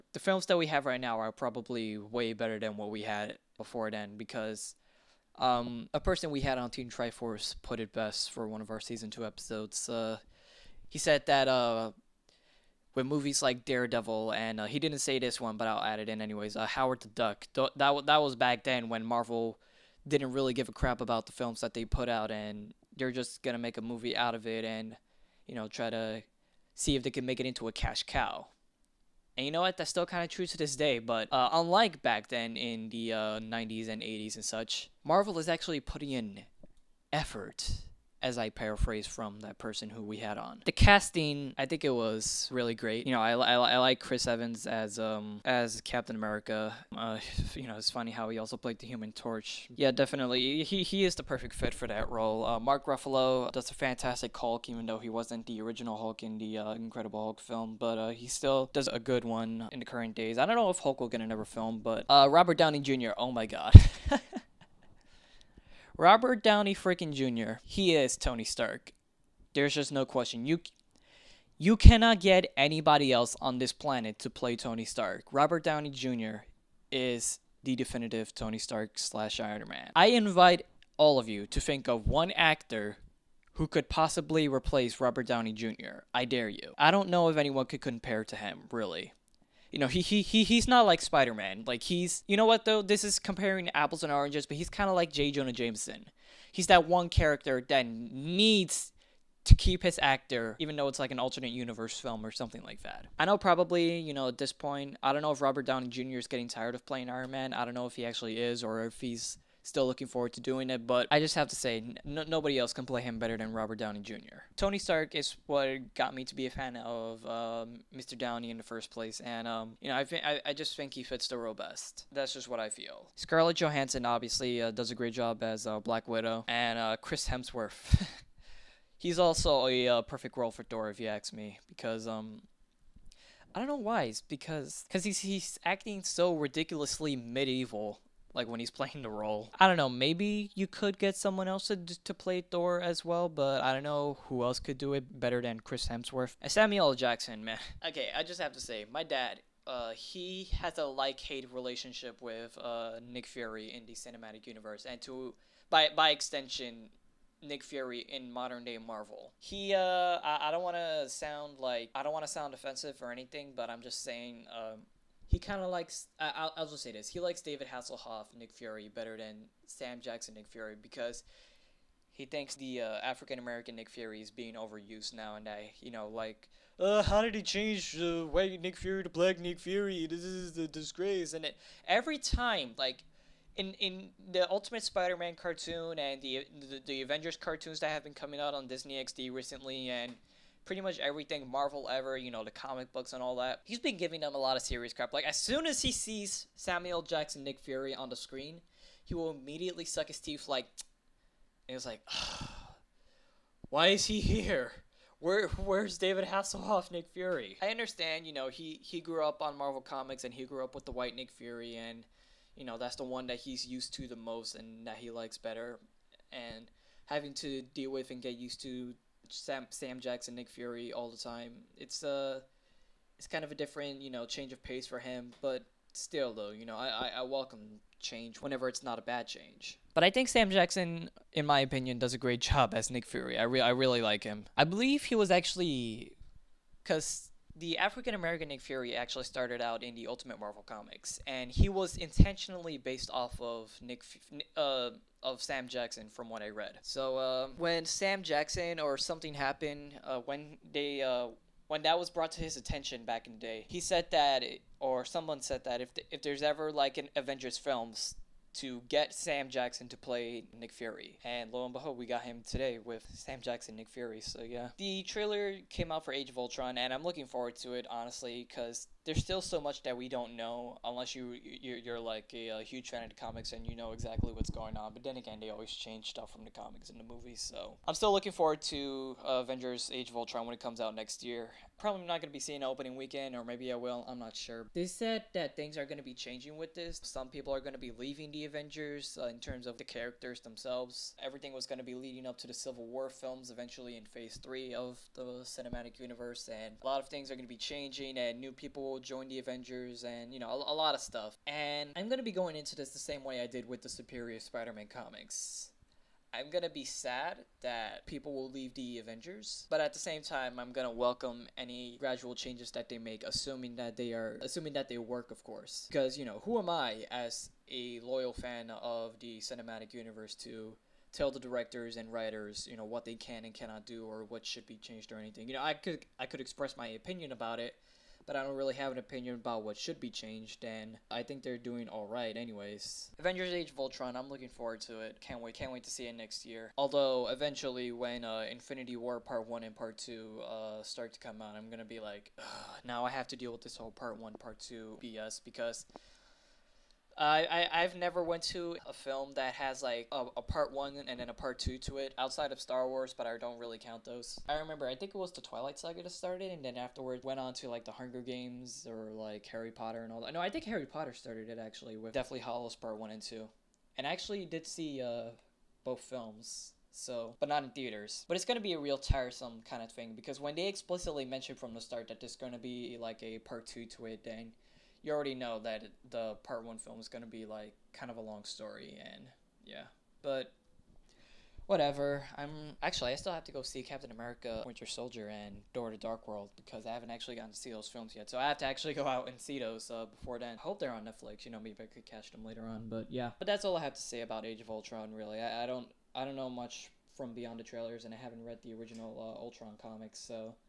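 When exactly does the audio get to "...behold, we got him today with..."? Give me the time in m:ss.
4:21.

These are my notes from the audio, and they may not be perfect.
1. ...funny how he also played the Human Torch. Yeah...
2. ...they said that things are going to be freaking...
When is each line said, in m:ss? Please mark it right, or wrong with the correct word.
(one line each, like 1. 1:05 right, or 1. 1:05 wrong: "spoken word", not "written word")
1. 0:47 right
2. 4:44 wrong: "changing", not "freaking".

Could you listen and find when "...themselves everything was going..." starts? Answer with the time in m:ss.
4:50.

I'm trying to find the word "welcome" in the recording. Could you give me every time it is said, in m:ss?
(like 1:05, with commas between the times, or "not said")
3:47, 5:10.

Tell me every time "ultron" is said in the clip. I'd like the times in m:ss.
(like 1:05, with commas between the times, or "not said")
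4:26, 4:40, 5:33, 6:34, 6:39.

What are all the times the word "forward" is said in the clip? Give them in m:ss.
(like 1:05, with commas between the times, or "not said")
1:50, 4:27, 4:38, 5:34.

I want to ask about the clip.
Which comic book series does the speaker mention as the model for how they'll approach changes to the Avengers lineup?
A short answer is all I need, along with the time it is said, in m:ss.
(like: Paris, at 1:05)
Superior Spider Man, at 5:03.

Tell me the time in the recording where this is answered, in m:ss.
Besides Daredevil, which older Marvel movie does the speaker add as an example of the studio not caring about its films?
0:16.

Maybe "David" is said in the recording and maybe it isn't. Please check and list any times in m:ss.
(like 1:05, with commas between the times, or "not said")
2:47, 3:25.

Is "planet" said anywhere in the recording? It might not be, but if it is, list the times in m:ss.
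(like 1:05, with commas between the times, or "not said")
1:13.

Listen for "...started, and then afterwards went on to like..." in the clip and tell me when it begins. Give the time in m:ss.
5:56.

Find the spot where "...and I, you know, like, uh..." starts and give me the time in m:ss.
2:55.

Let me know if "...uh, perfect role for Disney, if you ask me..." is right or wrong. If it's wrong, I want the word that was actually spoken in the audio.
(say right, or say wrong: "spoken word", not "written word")
wrong: "Thor", not "Disney".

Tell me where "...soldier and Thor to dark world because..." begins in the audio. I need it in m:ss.
6:24.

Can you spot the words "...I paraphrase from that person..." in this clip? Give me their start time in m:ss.
0:38.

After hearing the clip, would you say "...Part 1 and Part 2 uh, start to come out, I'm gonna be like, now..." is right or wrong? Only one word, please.
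right.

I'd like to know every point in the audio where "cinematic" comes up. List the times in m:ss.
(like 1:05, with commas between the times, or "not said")
2:33, 4:55, 5:19.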